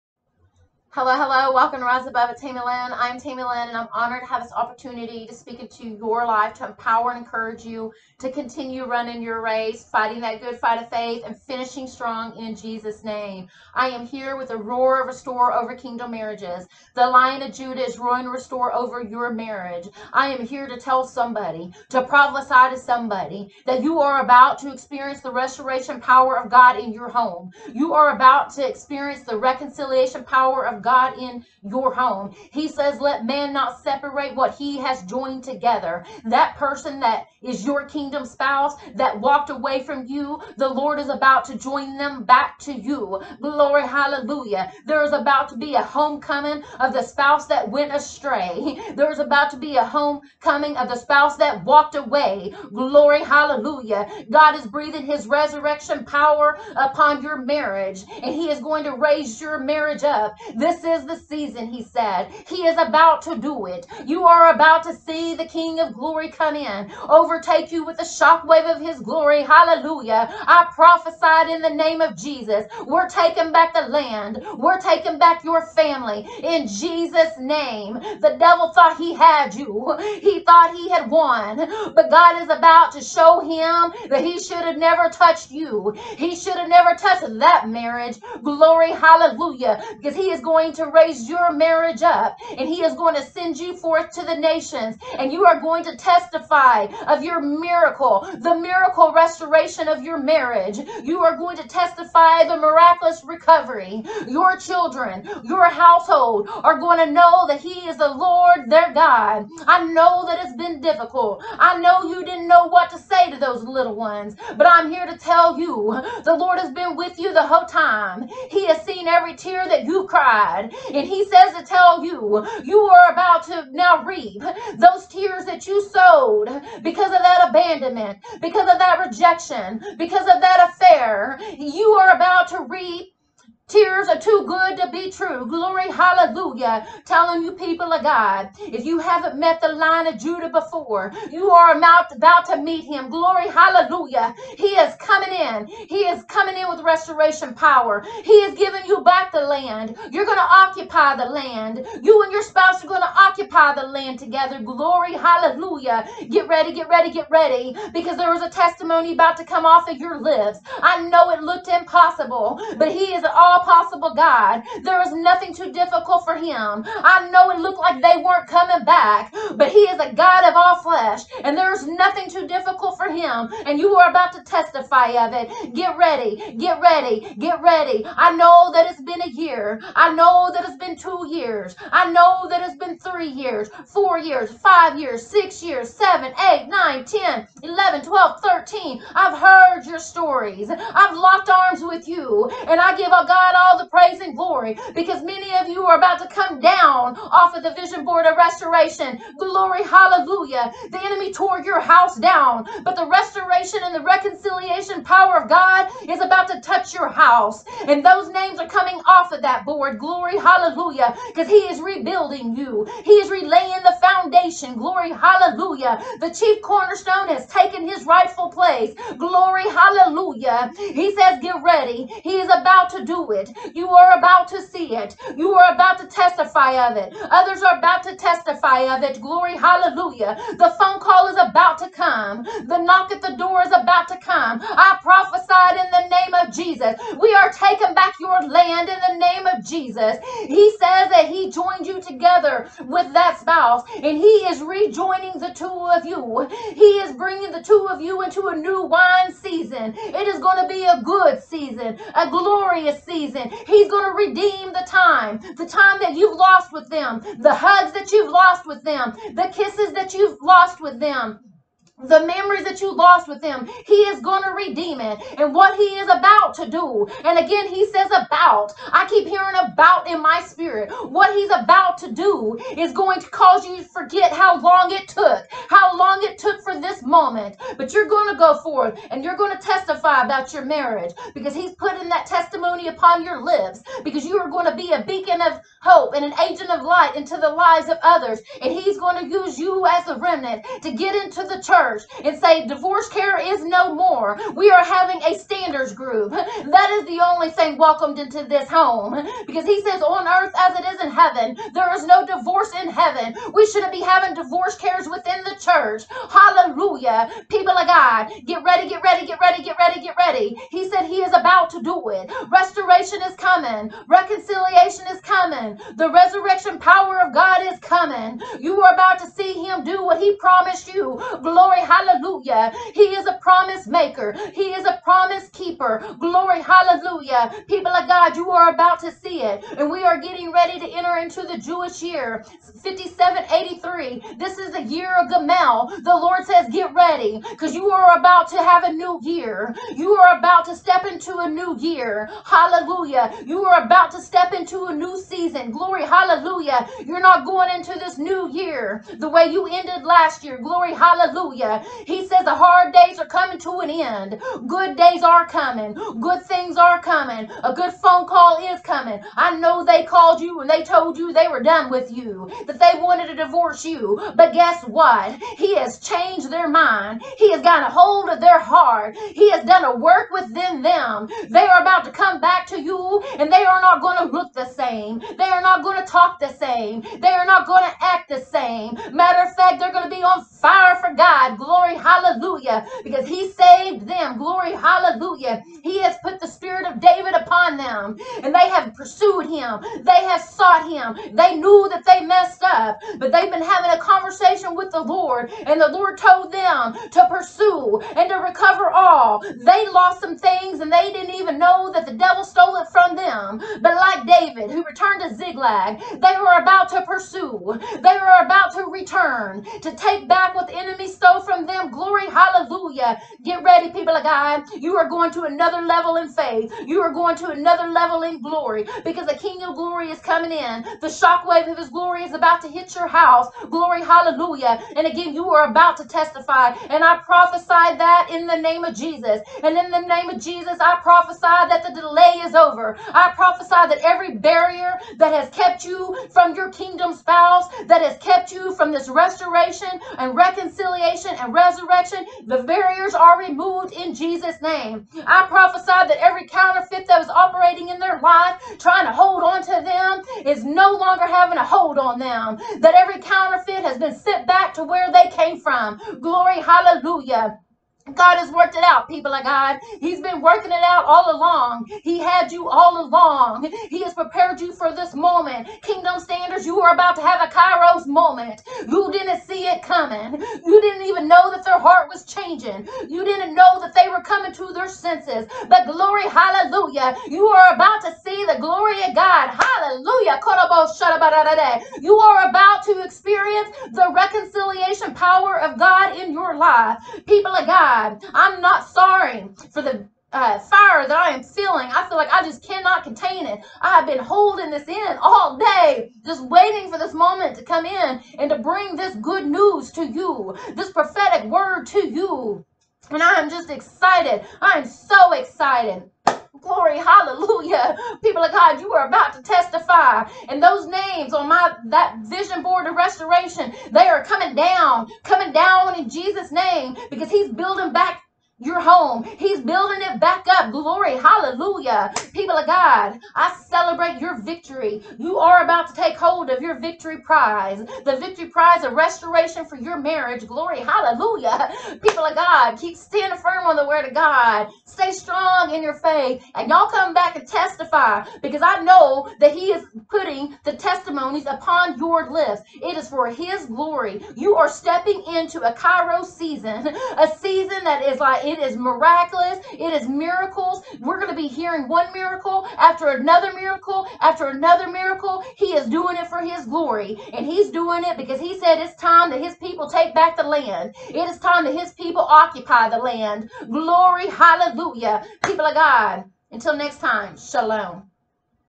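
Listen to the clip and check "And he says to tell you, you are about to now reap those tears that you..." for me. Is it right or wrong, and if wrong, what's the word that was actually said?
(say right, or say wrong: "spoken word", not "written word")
right.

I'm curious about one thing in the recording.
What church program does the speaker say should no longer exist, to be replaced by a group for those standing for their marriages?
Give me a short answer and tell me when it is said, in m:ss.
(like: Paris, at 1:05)
divorce care, at 4:52.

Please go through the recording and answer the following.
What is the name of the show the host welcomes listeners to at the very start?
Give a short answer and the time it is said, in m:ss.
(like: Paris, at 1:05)
Rise Above, at 0:01.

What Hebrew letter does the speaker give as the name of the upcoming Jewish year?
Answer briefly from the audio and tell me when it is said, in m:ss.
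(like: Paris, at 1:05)
Gamal, at 5:35.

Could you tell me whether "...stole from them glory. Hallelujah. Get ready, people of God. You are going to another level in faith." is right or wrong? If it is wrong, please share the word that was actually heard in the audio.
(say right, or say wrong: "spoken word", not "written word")
right.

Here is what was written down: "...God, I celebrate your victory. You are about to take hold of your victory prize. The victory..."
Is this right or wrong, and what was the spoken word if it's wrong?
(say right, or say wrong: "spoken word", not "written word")
right.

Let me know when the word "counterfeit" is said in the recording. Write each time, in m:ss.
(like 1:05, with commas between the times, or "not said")
7:26, 7:33.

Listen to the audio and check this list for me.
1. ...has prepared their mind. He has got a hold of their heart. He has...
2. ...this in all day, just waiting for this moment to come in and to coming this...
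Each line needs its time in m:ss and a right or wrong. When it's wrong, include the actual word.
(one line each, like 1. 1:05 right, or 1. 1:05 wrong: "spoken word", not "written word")
1. 6:05 wrong: "changed", not "prepared"
2. 8:14 wrong: "bring", not "coming".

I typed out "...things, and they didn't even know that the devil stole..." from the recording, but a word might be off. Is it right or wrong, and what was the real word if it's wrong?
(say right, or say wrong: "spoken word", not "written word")
right.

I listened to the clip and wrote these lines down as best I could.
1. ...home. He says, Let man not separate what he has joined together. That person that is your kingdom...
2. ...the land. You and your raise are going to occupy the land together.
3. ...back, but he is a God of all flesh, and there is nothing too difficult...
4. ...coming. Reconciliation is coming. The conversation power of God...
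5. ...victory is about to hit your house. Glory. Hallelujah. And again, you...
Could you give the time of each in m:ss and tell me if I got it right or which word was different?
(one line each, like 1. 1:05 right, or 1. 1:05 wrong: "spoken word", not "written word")
1. 0:31 right
2. 2:31 wrong: "spouse", not "raise"
3. 2:48 right
4. 5:13 wrong: "resurrection", not "conversation"
5. 7:01 wrong: "glory", not "victory".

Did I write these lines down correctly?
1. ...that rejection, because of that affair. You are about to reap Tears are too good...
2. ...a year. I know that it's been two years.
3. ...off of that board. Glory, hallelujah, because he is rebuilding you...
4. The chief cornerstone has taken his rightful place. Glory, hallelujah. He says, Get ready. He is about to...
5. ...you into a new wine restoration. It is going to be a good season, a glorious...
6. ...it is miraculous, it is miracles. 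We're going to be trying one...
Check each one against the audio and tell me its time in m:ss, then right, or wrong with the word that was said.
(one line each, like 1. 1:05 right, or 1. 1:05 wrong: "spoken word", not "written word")
1. 2:08 right
2. 2:59 right
3. 3:29 right
4. 3:36 right
5. 4:08 wrong: "season", not "restoration"
6. 9:08 wrong: "hearing", not "trying".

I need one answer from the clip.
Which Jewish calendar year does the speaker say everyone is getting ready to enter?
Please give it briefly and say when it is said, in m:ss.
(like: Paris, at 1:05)
5783, at 5:32.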